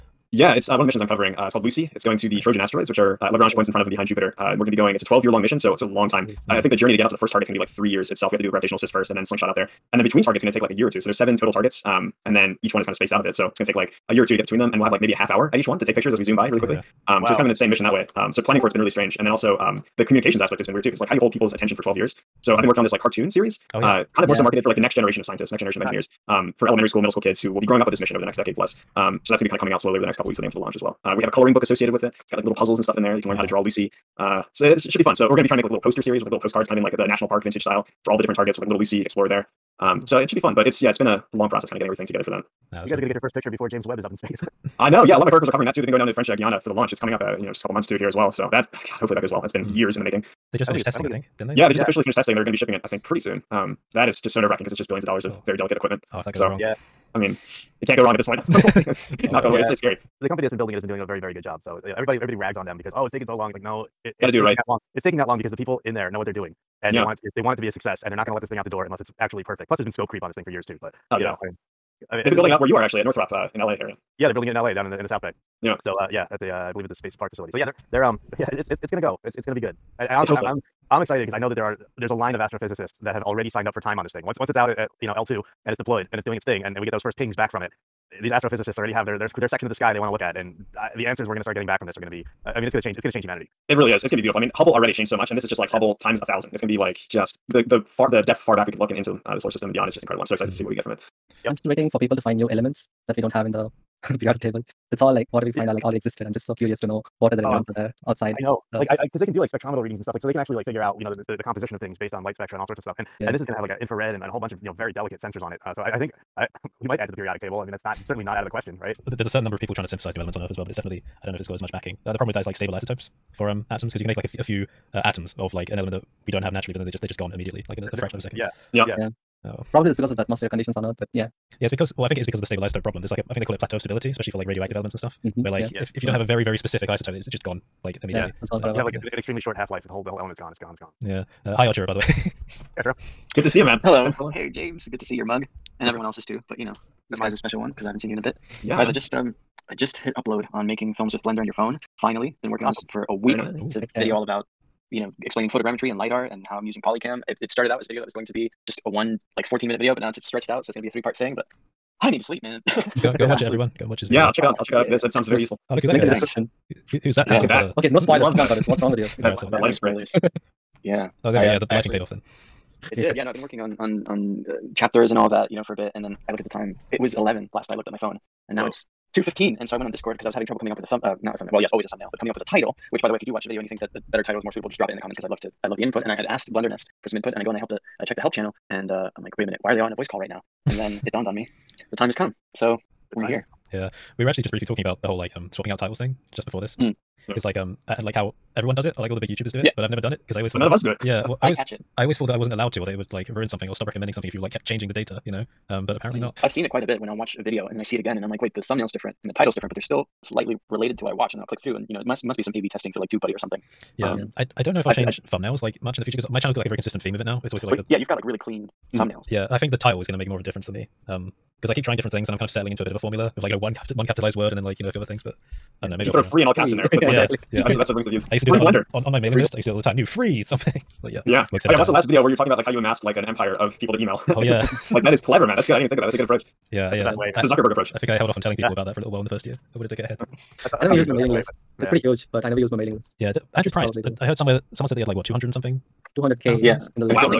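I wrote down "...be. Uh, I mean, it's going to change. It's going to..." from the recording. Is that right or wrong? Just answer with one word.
right.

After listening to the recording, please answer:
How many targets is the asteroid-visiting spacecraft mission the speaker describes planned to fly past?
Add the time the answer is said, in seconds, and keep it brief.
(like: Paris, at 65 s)
7, at 11 s.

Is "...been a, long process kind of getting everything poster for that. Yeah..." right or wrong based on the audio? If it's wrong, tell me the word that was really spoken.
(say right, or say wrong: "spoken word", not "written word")
wrong: "together", not "poster".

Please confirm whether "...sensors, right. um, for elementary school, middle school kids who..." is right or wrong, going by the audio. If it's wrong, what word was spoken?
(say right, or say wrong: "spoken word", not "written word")
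wrong: "engineers", not "sensors".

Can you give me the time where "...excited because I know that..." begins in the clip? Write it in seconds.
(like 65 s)
81 s.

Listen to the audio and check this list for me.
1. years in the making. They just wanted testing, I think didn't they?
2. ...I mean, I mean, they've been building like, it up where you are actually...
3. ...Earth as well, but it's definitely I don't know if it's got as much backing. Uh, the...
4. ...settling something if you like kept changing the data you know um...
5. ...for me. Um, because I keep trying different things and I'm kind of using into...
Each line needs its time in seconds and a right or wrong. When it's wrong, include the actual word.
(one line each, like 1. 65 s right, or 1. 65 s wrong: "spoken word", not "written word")
1. 49 s wrong: "finished", not "wanted"
2. 71 s right
3. 120 s right
4. 203 s wrong: "recommending", not "settling"
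5. 220 s wrong: "settling", not "using".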